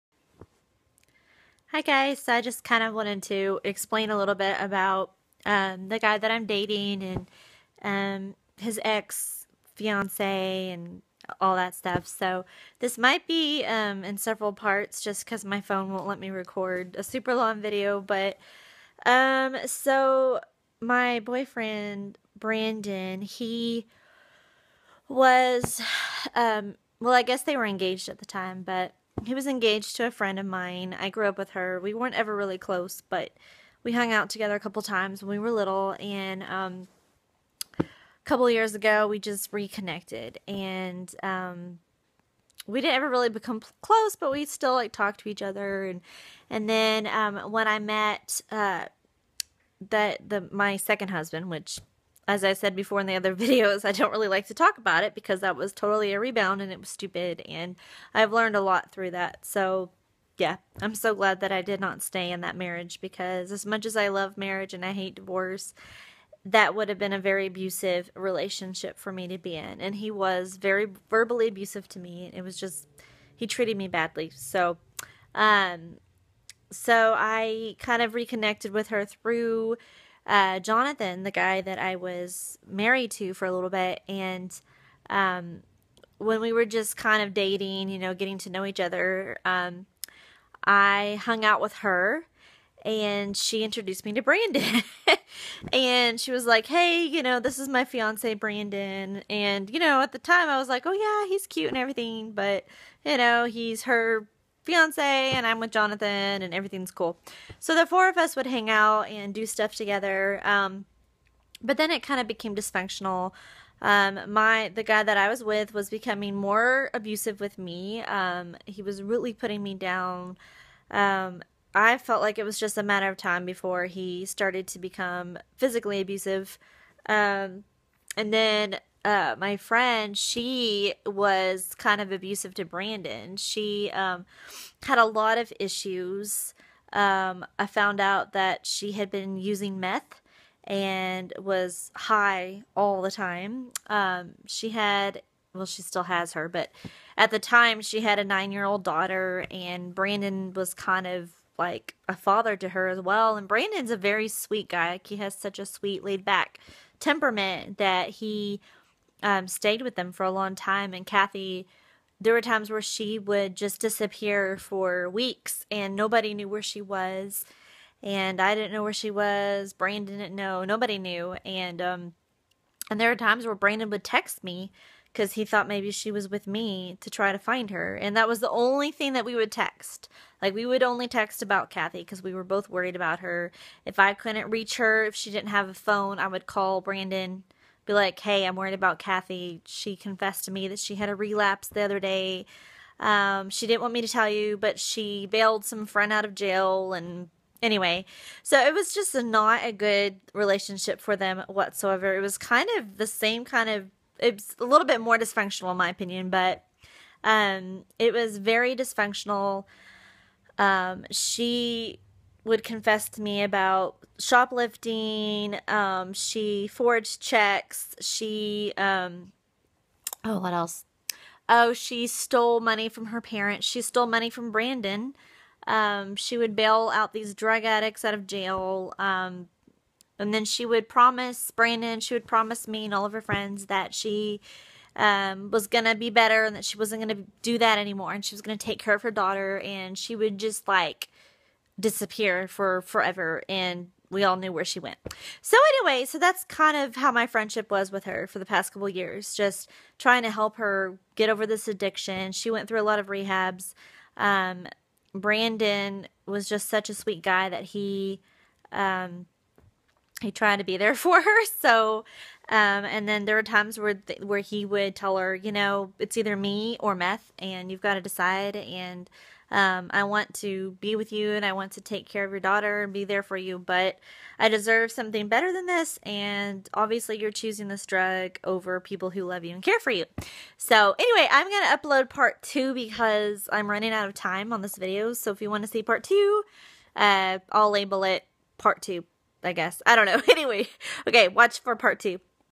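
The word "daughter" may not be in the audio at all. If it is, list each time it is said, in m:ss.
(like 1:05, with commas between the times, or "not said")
2:28, 3:59, 4:32.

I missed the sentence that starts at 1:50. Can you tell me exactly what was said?
Um, but then it kind of became dysfunctional.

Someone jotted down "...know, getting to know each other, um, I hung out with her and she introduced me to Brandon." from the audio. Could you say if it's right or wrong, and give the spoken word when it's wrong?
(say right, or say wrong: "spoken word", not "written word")
right.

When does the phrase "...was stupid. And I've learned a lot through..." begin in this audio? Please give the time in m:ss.
0:56.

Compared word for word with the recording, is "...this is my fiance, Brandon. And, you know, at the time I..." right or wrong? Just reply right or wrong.
right.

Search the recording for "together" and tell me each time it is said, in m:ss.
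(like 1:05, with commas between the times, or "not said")
0:34, 1:49.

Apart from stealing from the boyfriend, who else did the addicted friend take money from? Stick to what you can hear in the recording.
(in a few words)
Her parents.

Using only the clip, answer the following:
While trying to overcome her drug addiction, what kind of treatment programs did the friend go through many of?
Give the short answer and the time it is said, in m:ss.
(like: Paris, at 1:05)
Rehabs, at 4:13.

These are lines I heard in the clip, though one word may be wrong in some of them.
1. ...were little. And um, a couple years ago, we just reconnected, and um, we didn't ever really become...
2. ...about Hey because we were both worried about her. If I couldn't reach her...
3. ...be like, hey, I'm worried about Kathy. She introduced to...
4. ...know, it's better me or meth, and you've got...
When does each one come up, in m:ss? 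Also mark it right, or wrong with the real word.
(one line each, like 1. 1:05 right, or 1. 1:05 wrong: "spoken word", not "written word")
1. 0:35 right
2. 3:01 wrong: "Kathy", not "Hey"
3. 3:07 wrong: "confessed", not "introduced"
4. 4:25 wrong: "either", not "better".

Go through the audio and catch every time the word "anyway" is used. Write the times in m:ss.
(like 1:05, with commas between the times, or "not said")
3:17, 4:05, 4:40, 4:50.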